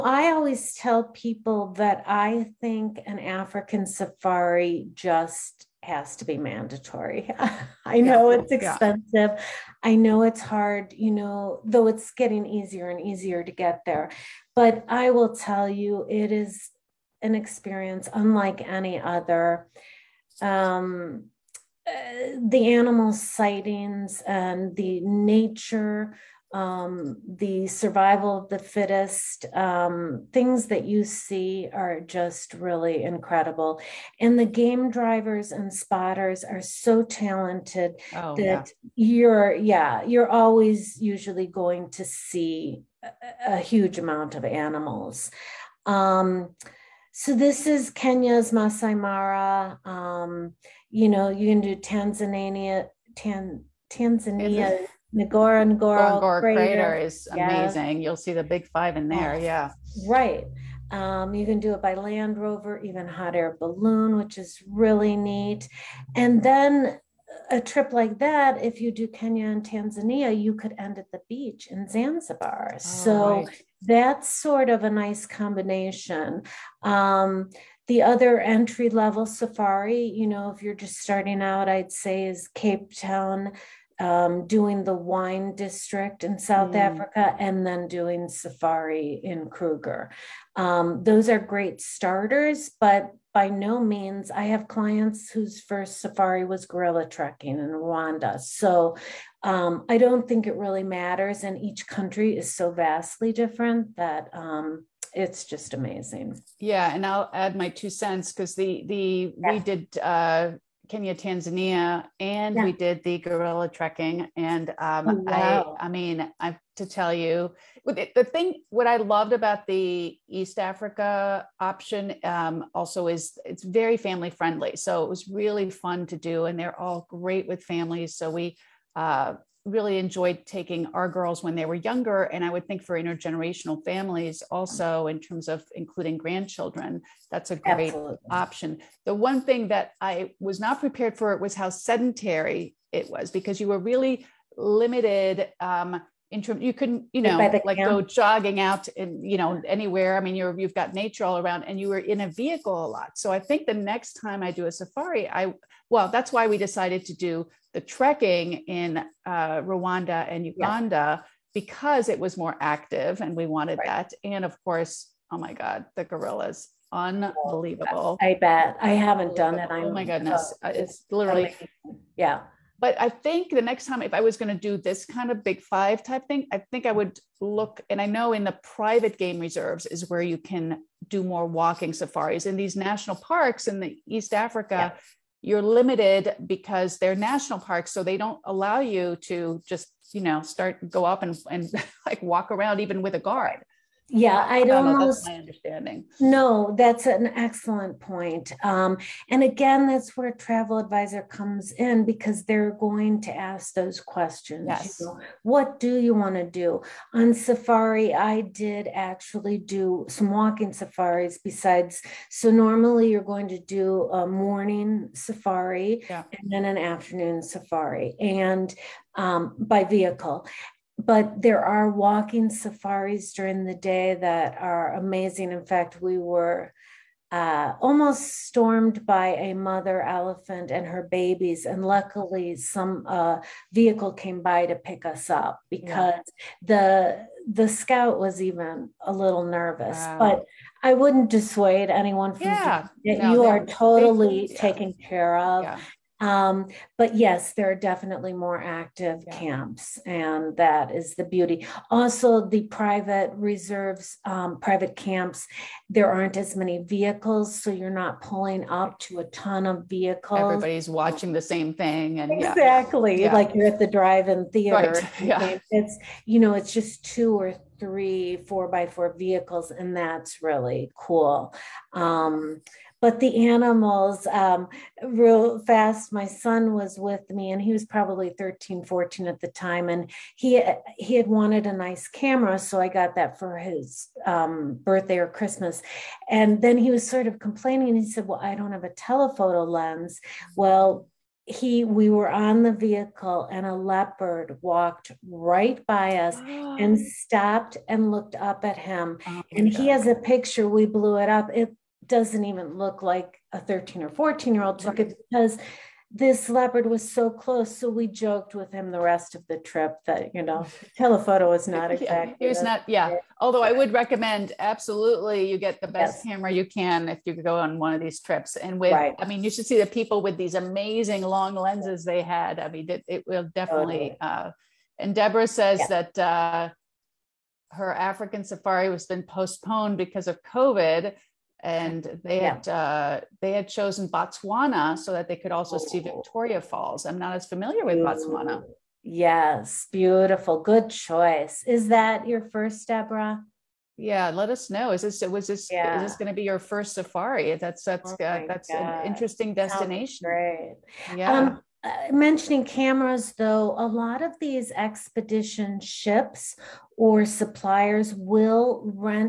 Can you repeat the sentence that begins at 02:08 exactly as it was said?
So we uh, really enjoyed taking our girls when they were younger.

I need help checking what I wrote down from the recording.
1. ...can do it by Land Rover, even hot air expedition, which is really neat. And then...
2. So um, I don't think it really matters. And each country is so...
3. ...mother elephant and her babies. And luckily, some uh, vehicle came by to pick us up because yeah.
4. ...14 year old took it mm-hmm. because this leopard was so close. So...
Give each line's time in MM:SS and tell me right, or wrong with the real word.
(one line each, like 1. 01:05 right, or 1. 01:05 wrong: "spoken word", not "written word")
1. 01:01 wrong: "balloon", not "expedition"
2. 01:38 right
3. 03:49 right
4. 05:04 right.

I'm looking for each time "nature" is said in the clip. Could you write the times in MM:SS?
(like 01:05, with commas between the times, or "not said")
00:25, 02:30.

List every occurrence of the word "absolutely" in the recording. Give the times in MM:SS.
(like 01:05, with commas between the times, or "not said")
02:17, 05:14.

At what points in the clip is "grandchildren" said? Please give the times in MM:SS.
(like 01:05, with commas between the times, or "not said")
02:16.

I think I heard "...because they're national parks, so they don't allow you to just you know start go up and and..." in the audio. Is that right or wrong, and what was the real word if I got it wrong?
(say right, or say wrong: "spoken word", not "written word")
right.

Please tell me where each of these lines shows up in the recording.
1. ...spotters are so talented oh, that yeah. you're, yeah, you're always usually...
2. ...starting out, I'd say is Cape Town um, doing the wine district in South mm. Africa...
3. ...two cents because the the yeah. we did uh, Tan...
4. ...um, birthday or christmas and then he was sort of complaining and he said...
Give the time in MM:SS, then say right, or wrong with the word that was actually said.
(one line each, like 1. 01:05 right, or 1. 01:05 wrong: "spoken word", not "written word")
1. 00:35 right
2. 01:20 right
3. 01:47 wrong: "Kenya", not "Tan"
4. 04:44 right.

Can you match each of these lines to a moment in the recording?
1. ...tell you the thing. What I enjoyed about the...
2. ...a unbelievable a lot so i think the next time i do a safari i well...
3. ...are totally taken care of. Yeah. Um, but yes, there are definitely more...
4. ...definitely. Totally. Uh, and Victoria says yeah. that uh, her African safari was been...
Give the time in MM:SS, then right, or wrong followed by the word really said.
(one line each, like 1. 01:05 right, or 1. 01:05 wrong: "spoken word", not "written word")
1. 01:56 wrong: "loved", not "enjoyed"
2. 02:32 wrong: "vehicle", not "unbelievable"
3. 04:03 right
4. 05:23 wrong: "Deborah", not "Victoria".